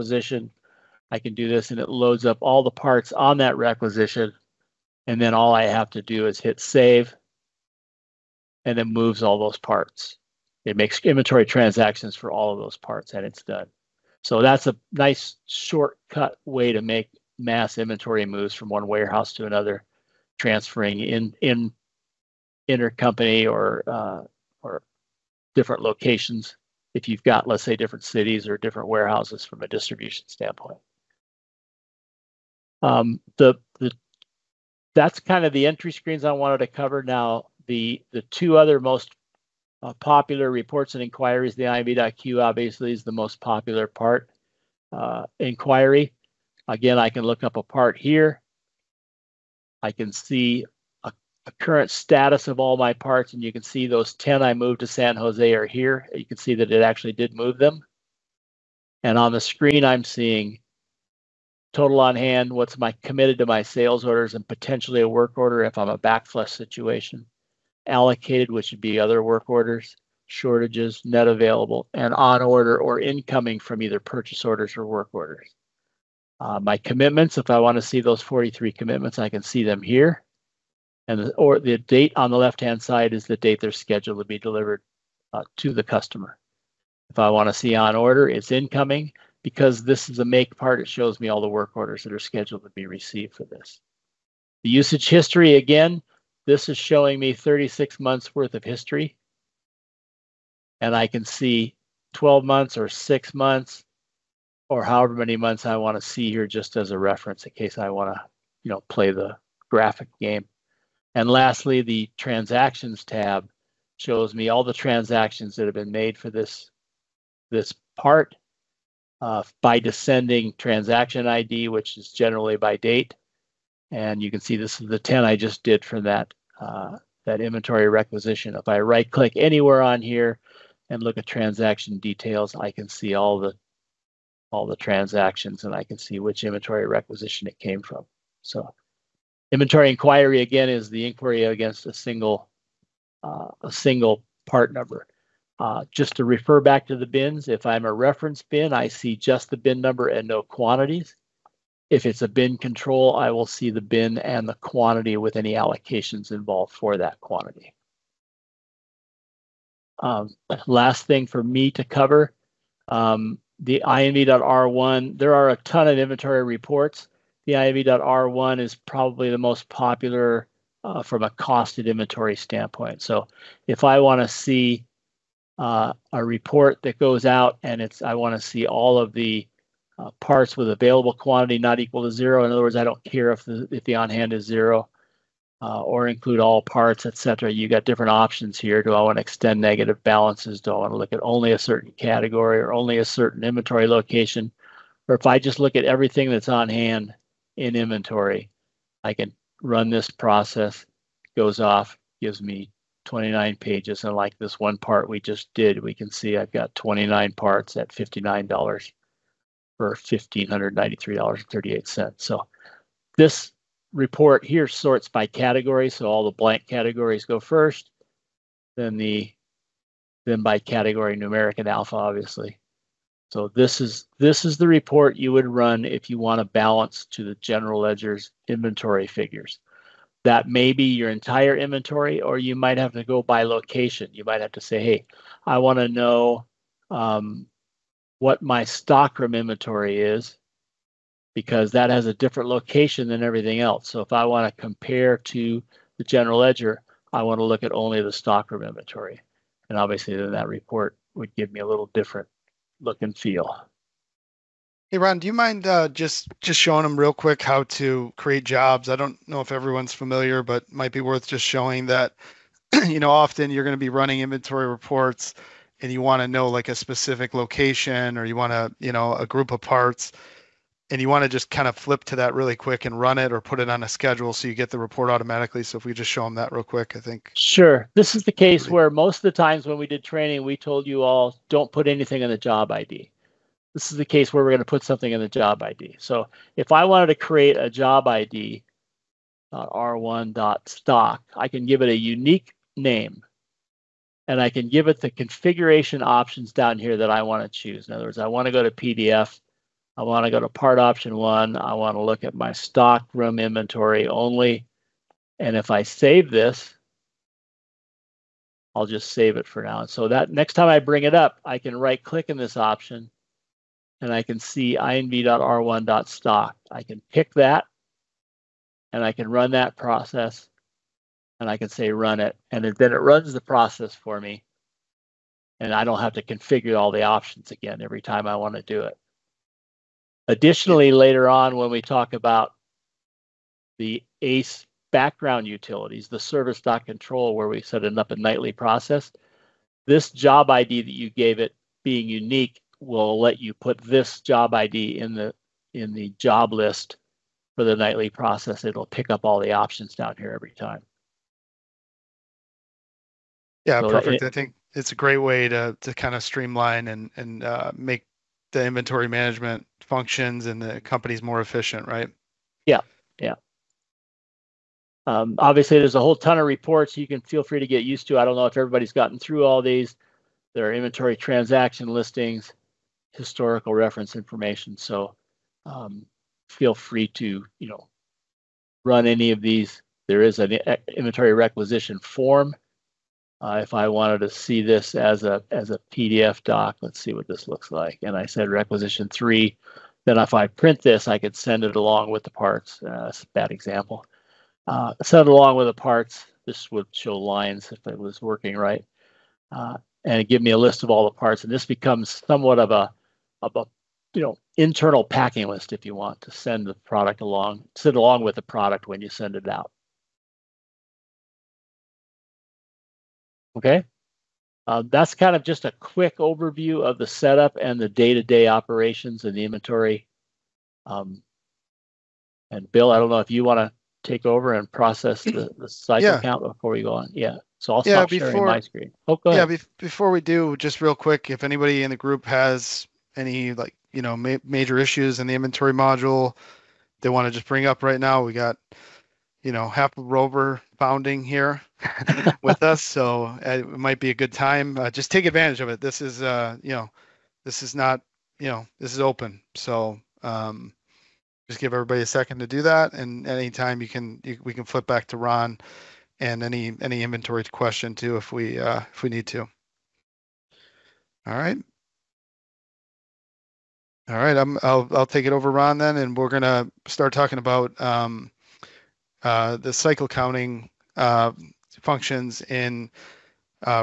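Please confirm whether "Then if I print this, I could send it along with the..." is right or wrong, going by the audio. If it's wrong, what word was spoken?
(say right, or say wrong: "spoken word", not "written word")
right.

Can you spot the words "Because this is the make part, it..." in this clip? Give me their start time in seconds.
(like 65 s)
89 s.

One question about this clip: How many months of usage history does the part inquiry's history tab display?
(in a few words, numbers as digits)
36.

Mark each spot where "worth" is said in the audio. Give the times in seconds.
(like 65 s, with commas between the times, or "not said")
98 s, 260 s.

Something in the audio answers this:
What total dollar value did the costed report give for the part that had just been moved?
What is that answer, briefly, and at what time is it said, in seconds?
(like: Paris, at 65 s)
$1,593.38, at 209 s.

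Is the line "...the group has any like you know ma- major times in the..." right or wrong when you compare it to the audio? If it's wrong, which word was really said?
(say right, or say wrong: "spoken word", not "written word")
wrong: "issues", not "times".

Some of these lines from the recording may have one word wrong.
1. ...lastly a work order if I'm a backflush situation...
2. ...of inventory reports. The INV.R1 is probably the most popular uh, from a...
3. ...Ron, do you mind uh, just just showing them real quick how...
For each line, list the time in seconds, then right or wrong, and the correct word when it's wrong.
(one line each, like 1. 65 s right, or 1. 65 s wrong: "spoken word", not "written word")
1. 64 s wrong: "potentially", not "lastly"
2. 165 s right
3. 254 s right.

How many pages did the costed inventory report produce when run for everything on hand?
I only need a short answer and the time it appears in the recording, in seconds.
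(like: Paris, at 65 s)
29 pages, at 203 s.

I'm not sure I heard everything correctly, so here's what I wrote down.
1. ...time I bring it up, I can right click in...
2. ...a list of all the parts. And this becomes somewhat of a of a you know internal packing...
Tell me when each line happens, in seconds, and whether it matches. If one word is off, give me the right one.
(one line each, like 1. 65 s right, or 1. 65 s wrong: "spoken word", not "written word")
1. 310 s right
2. 400 s right.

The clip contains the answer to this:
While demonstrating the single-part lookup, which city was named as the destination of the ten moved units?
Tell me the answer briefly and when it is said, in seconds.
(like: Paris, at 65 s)
San Jose, at 54 s.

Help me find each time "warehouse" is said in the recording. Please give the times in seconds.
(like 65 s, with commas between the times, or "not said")
18 s, 28 s.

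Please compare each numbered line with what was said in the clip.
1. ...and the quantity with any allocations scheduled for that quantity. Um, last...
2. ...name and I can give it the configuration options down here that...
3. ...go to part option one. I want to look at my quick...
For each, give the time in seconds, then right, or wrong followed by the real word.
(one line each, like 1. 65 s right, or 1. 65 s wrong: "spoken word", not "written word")
1. 154 s wrong: "involved", not "scheduled"
2. 292 s right
3. 300 s wrong: "stock", not "quick".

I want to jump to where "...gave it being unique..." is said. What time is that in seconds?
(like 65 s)
341 s.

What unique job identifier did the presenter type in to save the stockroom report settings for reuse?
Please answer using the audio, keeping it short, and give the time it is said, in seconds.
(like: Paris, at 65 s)
r1.stock, at 289 s.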